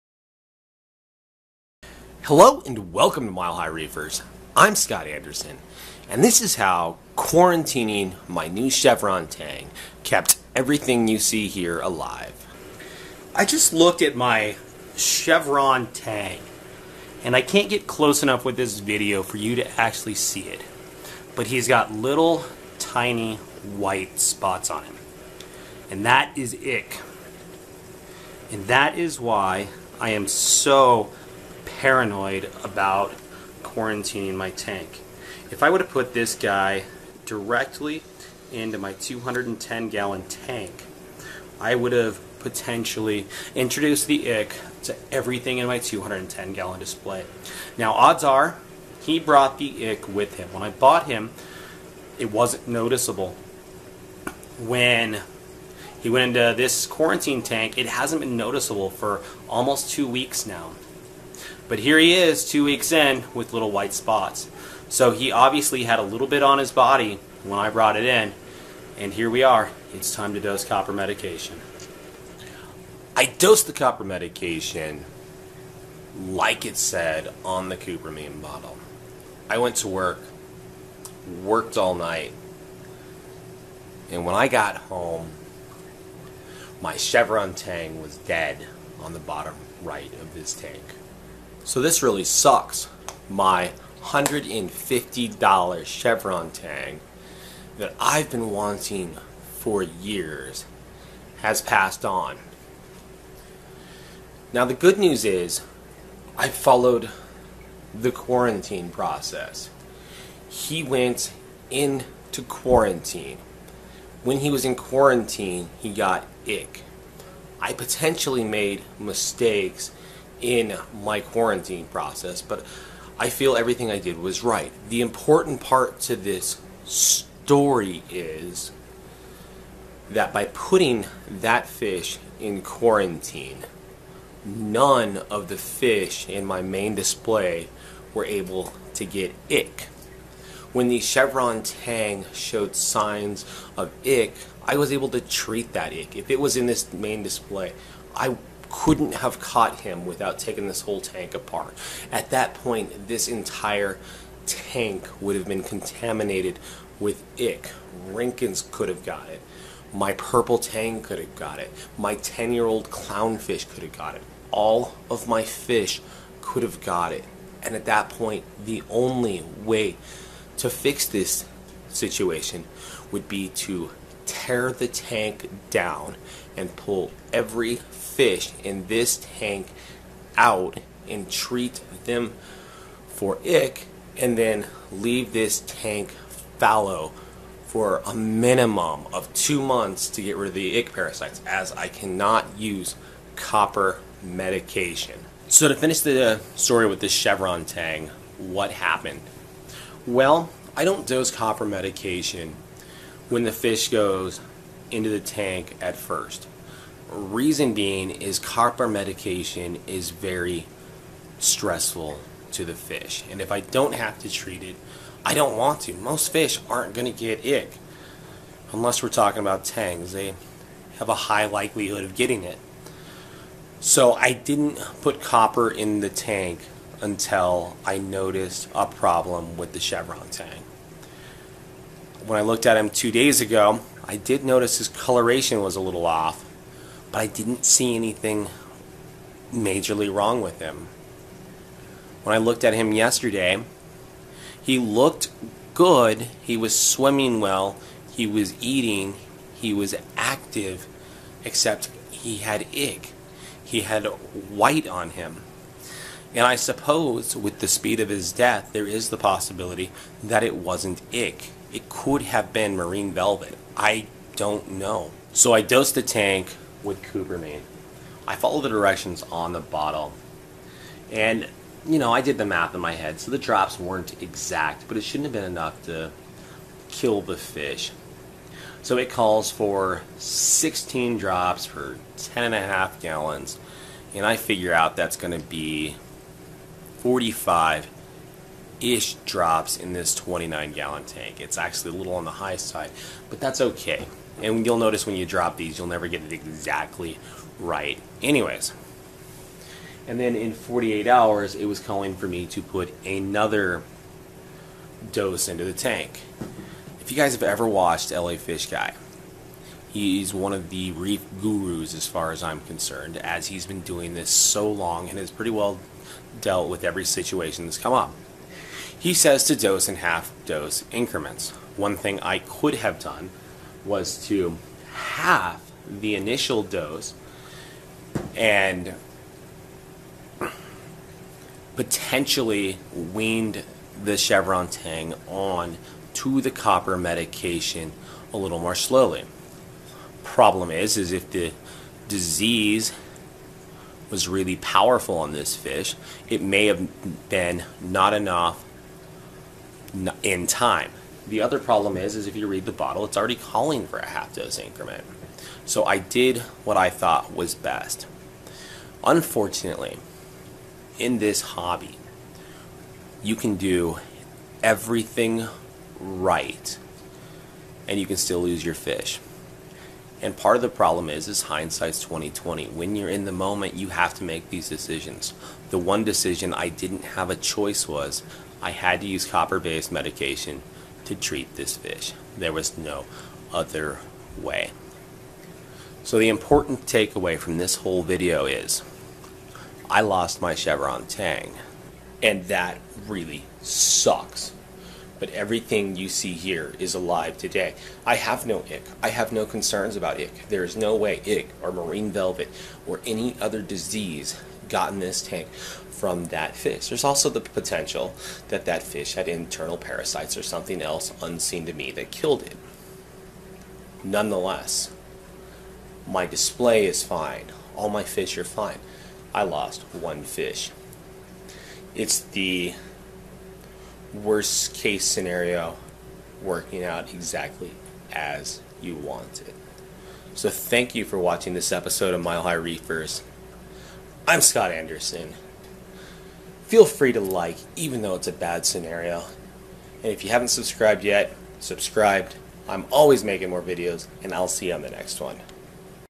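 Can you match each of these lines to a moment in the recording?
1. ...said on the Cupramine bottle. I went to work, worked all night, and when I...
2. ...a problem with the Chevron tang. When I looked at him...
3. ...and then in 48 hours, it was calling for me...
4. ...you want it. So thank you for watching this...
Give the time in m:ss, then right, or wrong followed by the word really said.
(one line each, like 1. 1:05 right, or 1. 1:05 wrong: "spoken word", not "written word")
1. 1:16 right
2. 3:48 right
3. 5:00 right
4. 7:08 right.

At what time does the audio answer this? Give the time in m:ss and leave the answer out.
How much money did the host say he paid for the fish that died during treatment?
1:34.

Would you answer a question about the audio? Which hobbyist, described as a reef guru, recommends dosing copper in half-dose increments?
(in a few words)
LA Fish Guy.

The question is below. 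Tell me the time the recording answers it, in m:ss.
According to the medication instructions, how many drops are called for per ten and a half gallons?
4:40.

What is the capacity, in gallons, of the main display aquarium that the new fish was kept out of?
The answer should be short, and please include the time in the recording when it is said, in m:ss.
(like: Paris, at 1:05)
210 gallons, at 0:45.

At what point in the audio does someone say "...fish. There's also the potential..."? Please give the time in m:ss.
6:46.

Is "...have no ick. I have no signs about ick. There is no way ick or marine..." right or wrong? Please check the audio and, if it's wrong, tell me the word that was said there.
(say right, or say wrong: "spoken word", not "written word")
wrong: "concerns", not "signs".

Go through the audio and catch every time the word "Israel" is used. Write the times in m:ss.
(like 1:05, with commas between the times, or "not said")
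not said.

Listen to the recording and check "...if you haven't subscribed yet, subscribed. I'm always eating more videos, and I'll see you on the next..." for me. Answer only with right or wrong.
wrong.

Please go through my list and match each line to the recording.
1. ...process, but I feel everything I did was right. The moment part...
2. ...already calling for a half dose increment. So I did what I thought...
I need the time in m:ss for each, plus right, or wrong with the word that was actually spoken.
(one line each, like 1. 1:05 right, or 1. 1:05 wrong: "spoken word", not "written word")
1. 2:01 wrong: "important", not "moment"
2. 5:53 right.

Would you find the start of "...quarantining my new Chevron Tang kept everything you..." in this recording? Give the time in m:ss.
0:07.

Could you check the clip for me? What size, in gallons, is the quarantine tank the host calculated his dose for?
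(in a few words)
29 gallons.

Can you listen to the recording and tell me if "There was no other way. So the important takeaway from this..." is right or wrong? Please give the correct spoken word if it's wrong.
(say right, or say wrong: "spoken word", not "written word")
right.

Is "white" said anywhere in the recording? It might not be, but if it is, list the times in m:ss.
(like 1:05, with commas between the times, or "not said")
0:23, 1:03, 4:14.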